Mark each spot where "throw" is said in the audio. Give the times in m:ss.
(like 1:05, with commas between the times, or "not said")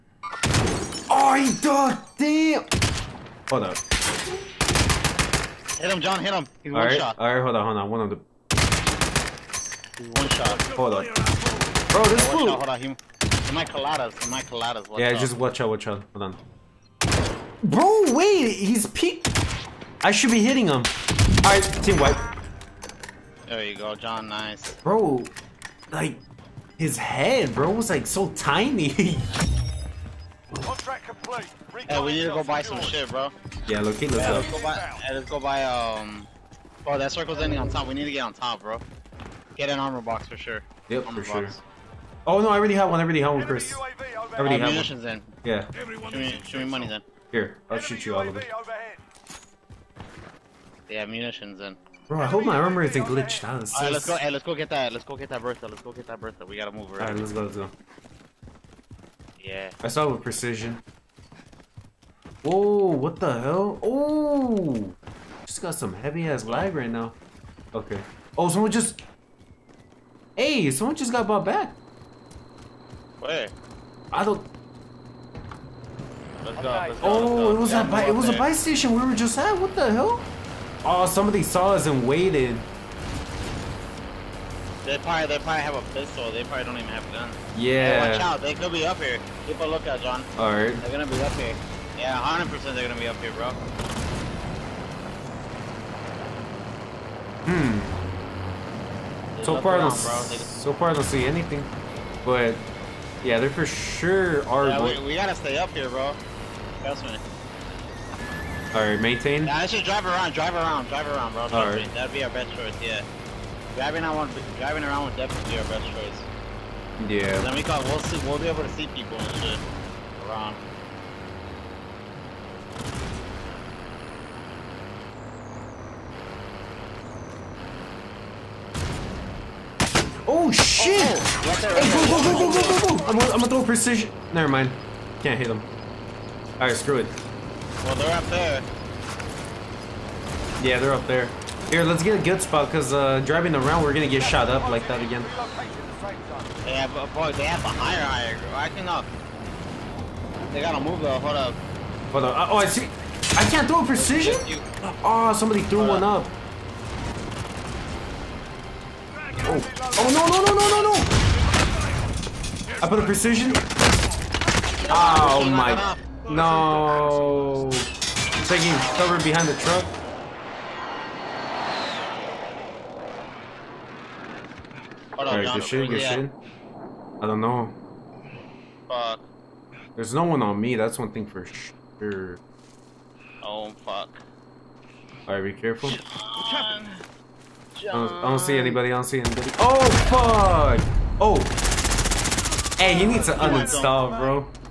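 2:13, 2:33.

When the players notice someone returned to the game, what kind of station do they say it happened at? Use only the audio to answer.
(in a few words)
a buy station.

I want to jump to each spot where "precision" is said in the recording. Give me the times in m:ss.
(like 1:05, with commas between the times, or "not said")
1:00, 2:13, 2:33, 2:43.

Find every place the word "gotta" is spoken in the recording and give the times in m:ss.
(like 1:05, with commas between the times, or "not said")
0:56, 1:45, 2:30.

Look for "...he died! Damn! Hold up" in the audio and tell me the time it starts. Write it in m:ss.
0:01.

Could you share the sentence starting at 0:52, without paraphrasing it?
Bro, I hope my armor isn't glitched.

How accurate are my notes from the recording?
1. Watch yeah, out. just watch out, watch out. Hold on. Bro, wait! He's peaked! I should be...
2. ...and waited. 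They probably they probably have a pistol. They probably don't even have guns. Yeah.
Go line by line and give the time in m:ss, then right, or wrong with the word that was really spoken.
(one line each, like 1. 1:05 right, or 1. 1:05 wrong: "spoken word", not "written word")
1. 0:14 right
2. 1:21 right.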